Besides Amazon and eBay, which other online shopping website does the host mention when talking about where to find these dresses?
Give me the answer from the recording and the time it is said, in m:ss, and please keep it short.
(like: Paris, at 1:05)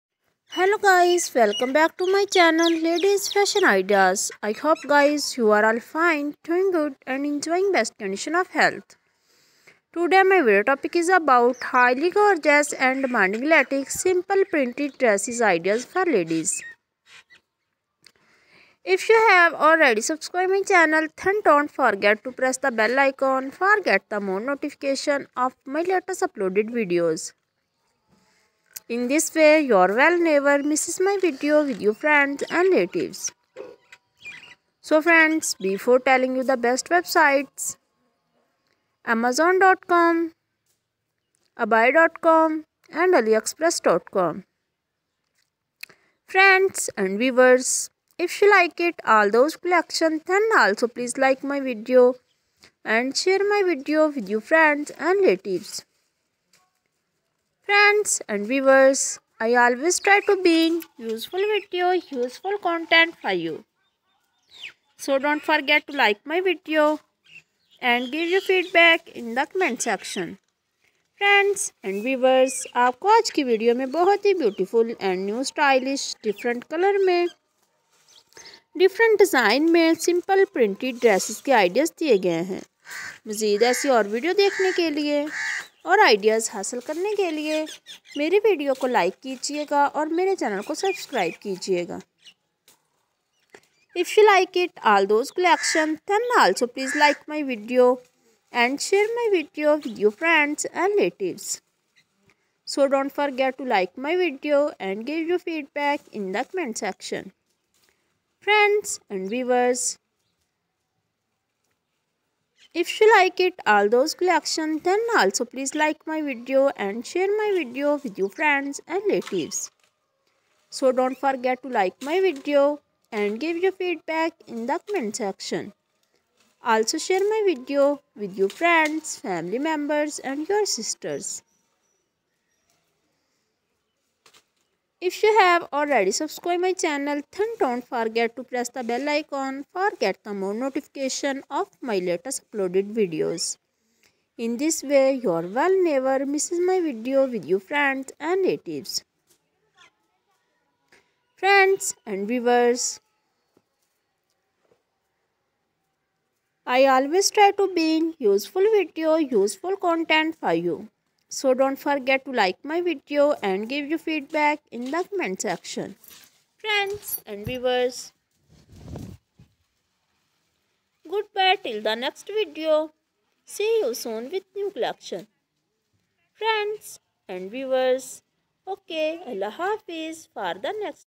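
AliExpress.com, at 0:43.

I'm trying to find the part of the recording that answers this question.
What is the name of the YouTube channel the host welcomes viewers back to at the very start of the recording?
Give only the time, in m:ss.
0:02.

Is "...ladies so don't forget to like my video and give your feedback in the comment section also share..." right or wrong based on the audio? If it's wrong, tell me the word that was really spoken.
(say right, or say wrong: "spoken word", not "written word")
wrong: "relatives", not "ladies".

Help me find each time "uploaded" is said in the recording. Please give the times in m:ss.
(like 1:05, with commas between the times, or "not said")
0:26, 2:22.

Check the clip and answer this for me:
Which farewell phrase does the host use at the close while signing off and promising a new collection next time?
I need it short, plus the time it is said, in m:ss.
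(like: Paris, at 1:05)
Allah Hafiz, at 2:59.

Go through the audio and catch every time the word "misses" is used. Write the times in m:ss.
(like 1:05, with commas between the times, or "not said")
0:30, 2:26.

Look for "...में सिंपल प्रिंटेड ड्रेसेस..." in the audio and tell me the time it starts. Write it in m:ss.
1:19.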